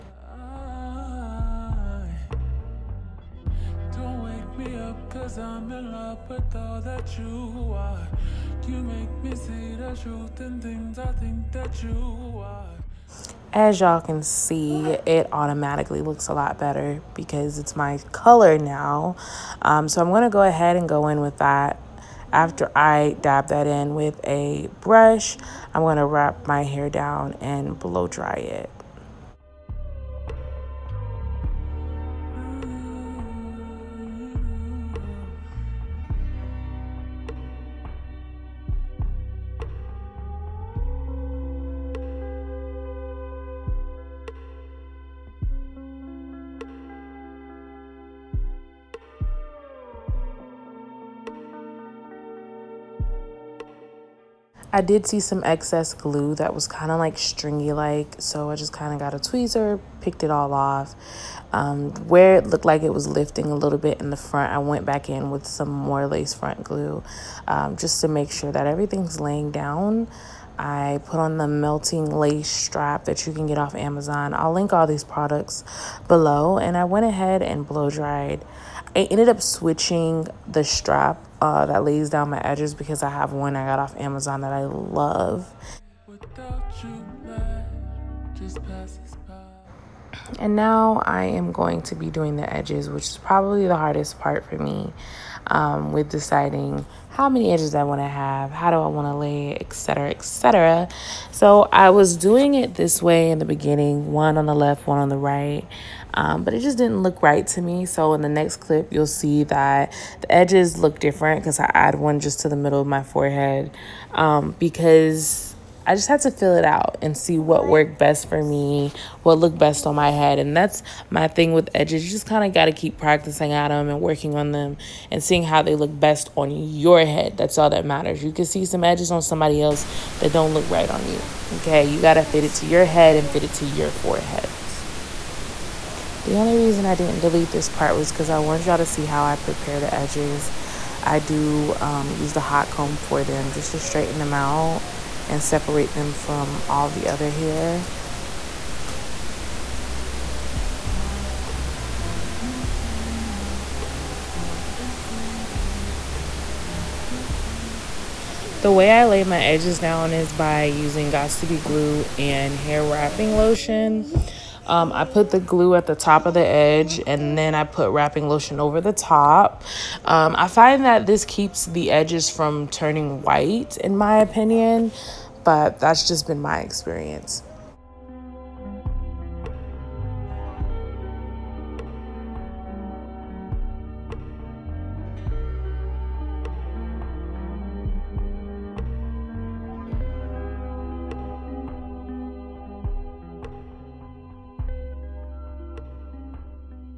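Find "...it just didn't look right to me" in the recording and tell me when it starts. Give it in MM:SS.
01:46.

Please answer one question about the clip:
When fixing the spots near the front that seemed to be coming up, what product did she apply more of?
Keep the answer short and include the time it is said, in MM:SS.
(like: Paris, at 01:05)
lace front glue, at 01:06.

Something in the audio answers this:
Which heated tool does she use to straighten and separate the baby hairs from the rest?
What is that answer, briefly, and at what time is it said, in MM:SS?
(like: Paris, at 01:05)
hot comb, at 02:22.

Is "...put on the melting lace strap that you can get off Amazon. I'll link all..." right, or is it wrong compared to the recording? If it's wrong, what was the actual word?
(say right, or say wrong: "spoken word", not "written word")
right.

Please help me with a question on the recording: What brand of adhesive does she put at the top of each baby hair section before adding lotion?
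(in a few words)
Gots to Be Glue.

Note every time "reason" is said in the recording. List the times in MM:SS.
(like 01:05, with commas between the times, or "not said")
02:16.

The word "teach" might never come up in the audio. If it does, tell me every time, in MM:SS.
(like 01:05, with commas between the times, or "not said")
not said.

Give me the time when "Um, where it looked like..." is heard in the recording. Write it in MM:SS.
01:01.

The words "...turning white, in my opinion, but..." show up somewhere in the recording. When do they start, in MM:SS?
02:52.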